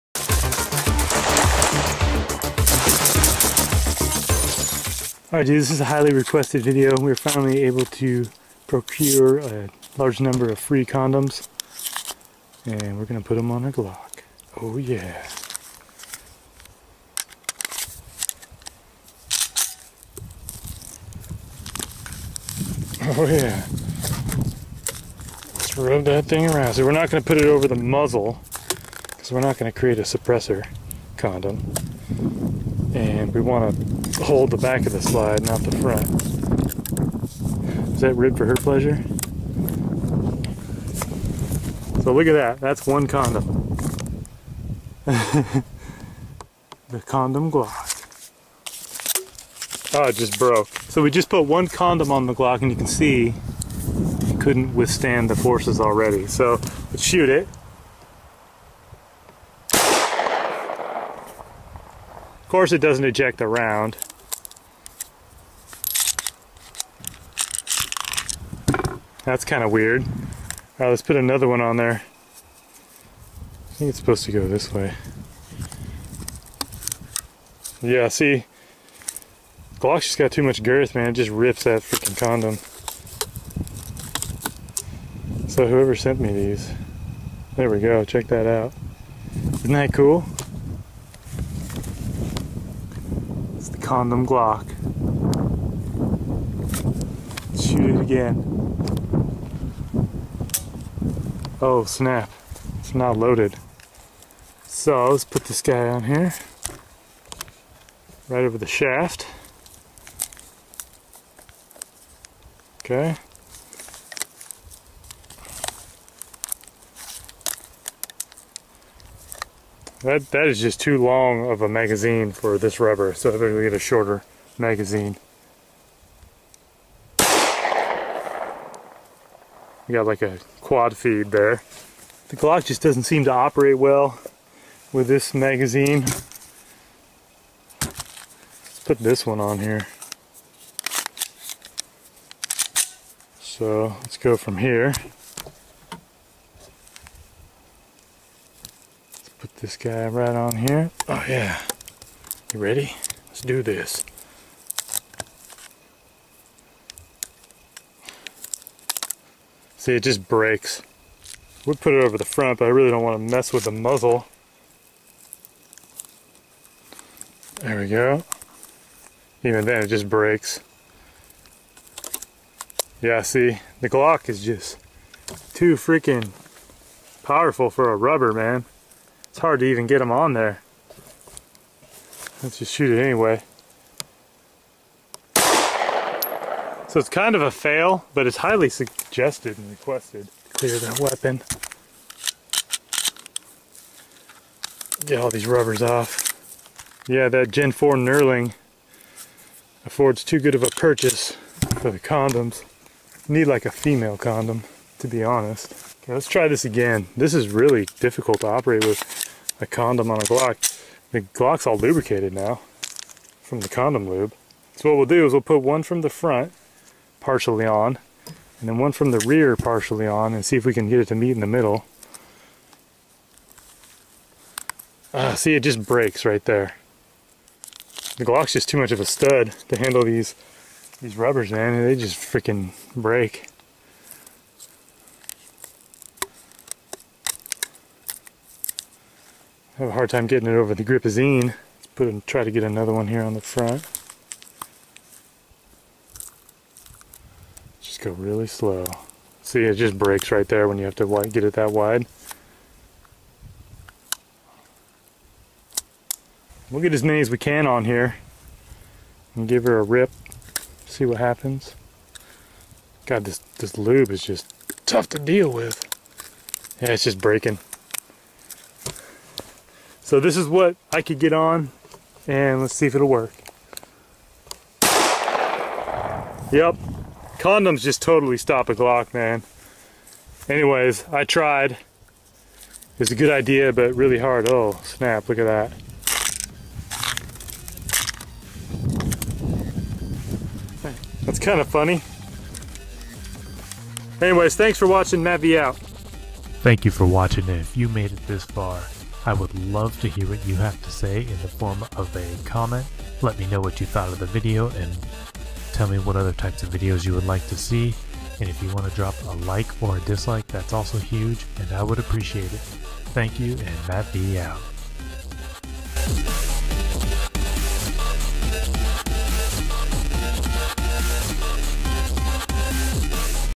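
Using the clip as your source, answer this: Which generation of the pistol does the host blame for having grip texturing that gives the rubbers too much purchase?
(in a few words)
Gen 4.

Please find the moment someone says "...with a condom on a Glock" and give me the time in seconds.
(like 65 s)
208 s.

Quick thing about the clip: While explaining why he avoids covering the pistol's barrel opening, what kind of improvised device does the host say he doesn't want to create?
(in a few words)
suppressor condom.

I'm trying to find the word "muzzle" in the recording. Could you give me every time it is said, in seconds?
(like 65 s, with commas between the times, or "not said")
27 s, 163 s.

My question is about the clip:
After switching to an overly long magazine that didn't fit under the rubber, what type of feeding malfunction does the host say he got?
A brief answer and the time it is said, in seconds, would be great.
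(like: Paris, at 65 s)
quad feed, at 130 s.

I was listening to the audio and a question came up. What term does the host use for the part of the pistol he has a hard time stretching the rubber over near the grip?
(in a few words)
gripazine.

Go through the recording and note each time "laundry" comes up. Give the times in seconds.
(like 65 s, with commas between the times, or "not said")
not said.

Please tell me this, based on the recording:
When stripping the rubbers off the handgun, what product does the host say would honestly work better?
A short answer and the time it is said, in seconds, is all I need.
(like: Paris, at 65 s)
female condom, at 203 s.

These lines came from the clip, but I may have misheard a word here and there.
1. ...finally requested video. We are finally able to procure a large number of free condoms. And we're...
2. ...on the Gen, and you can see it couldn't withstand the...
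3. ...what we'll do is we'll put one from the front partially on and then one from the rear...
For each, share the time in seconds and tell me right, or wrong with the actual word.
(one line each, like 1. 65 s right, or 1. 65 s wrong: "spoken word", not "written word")
1. 5 s wrong: "highly", not "finally"
2. 52 s wrong: "Glock", not "Gen"
3. 214 s right.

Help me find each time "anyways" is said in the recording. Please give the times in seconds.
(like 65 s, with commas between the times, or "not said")
183 s, 280 s, 294 s.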